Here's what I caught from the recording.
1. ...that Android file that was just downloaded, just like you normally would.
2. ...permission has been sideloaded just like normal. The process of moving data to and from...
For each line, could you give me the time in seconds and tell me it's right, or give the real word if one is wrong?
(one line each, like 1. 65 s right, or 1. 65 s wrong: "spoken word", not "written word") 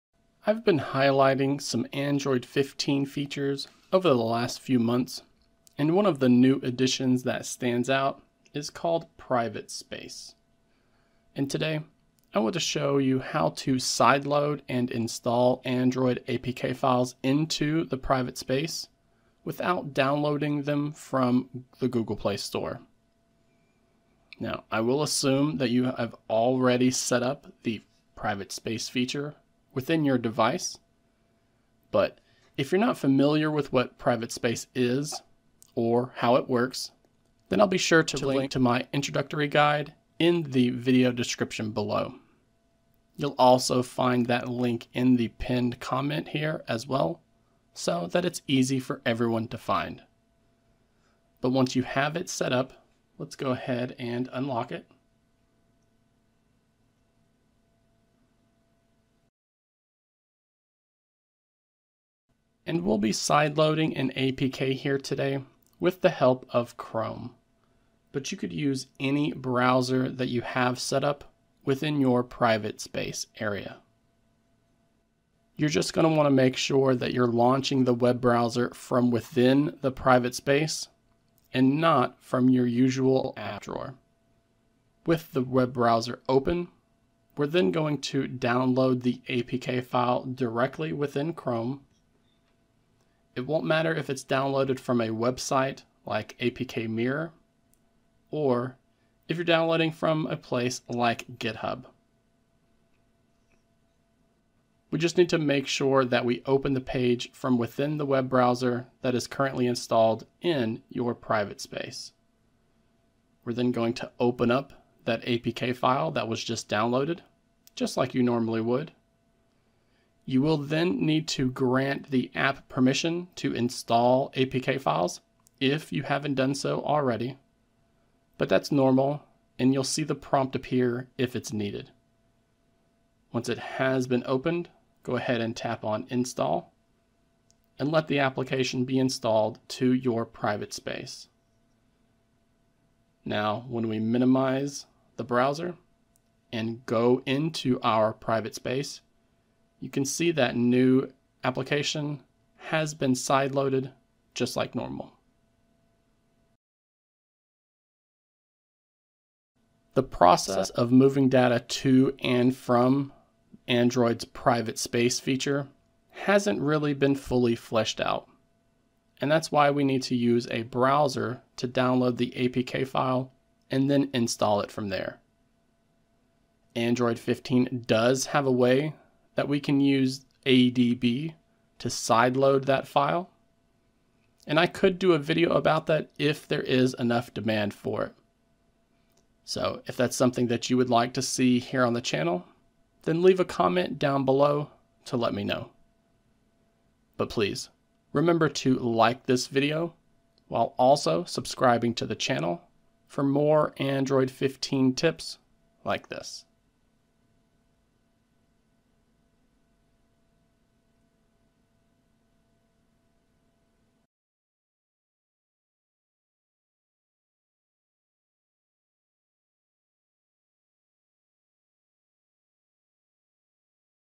1. 115 s wrong: "APK", not "Android"
2. 151 s wrong: "application", not "permission".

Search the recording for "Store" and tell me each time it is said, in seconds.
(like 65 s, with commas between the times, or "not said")
22 s.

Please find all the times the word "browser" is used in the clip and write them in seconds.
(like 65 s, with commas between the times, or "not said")
69 s, 78 s, 85 s, 108 s, 145 s, 170 s.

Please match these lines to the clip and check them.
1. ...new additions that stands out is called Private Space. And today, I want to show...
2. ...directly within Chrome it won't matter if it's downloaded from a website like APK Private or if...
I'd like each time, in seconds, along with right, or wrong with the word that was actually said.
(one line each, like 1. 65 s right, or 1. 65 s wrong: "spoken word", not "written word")
1. 6 s right
2. 90 s wrong: "Mirror", not "Private".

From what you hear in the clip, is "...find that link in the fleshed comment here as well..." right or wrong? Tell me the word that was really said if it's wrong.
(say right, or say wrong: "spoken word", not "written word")
wrong: "pinned", not "fleshed".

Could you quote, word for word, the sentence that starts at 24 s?
Now, I will assume that you have already set up the private space feature within your device.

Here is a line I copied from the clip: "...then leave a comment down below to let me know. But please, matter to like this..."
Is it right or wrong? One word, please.
wrong.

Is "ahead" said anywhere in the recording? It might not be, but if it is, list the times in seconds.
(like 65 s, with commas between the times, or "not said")
53 s, 135 s.